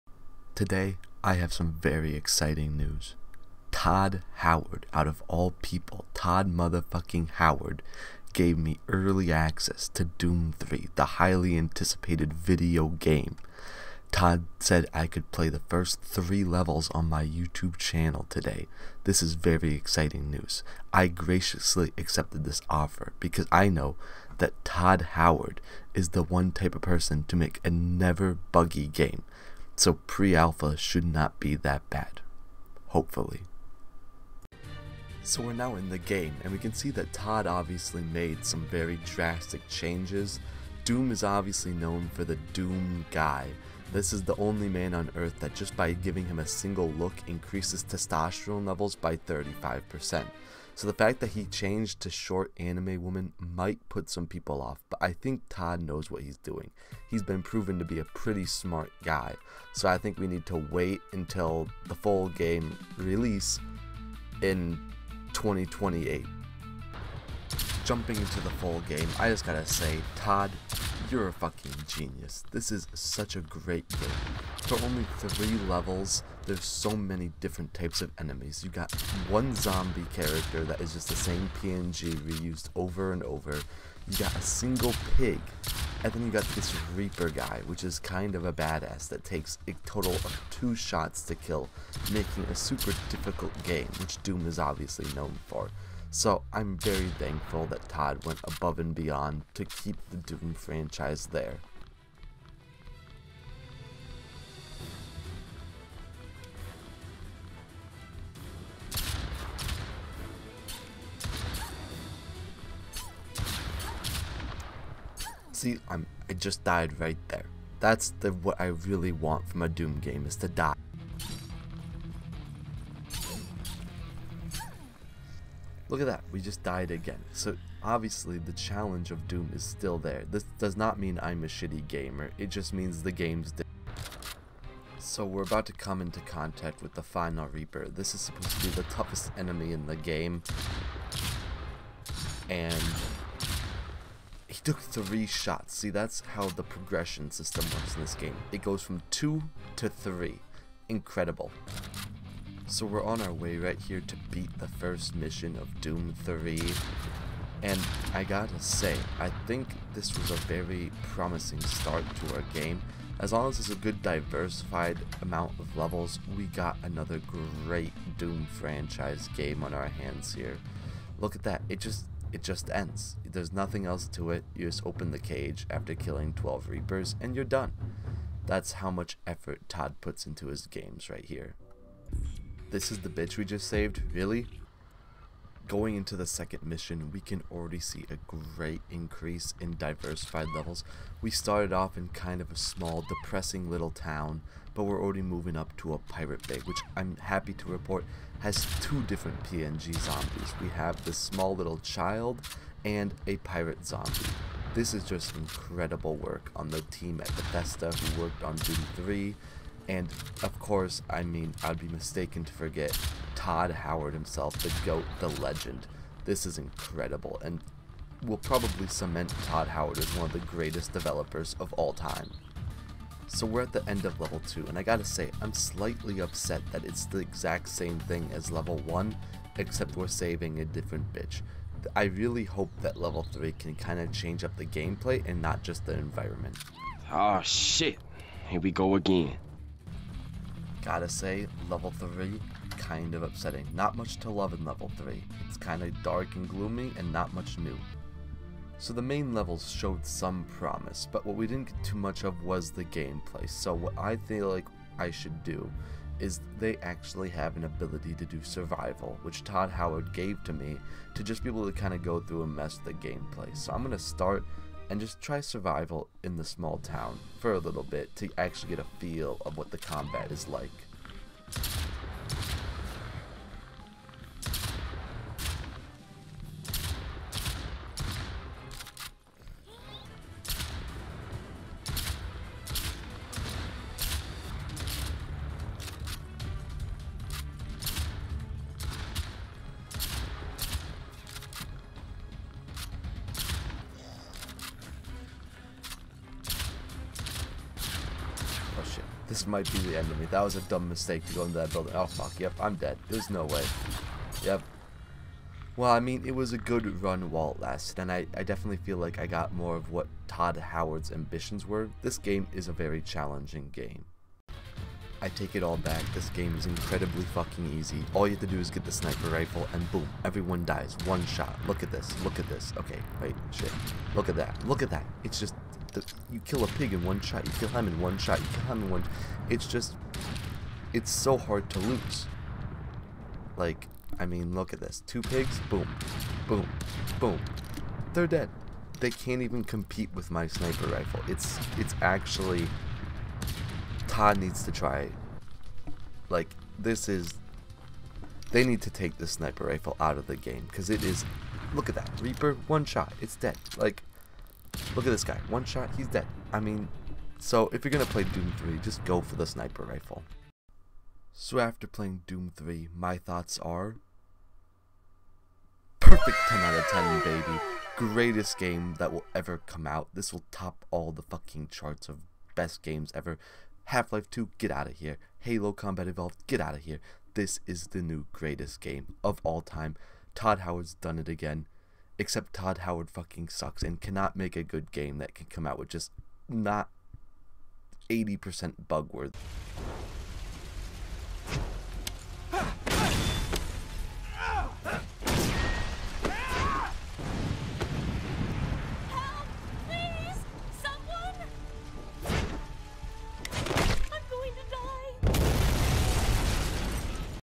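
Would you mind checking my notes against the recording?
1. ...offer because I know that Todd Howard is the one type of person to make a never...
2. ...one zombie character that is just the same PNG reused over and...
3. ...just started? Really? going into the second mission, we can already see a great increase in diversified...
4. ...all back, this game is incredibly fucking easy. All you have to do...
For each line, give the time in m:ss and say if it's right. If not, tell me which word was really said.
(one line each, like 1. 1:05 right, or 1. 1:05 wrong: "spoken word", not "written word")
1. 0:22 right
2. 1:19 right
3. 3:03 wrong: "saved", not "started"
4. 5:15 right.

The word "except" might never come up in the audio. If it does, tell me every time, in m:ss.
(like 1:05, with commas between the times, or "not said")
3:49, 6:22.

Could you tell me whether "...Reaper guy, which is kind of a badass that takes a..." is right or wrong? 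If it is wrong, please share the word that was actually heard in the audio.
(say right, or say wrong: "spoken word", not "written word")
right.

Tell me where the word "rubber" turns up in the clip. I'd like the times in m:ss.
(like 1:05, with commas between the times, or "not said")
not said.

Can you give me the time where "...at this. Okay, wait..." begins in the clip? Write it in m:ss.
5:22.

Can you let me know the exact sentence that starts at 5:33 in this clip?
Like, I mean, look at this.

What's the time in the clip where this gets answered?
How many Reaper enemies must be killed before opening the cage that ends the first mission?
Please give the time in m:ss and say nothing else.
2:56.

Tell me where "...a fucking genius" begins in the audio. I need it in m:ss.
1:11.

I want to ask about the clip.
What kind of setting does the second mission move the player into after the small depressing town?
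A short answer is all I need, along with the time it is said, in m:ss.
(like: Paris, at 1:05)
A pirate bay, at 3:15.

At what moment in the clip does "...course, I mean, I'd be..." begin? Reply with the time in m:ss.
3:30.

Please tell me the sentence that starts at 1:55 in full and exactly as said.
see, I'm I just died right there.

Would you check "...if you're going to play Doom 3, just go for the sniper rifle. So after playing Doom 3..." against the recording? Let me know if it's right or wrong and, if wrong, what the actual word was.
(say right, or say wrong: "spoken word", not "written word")
right.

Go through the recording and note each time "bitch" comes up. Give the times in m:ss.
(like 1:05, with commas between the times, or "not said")
3:03, 3:51.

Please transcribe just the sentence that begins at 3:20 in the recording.
We have this small little child and a pirate zombie.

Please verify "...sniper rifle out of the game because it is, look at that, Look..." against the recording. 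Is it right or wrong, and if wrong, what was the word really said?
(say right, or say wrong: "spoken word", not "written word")
wrong: "Reaper", not "Look".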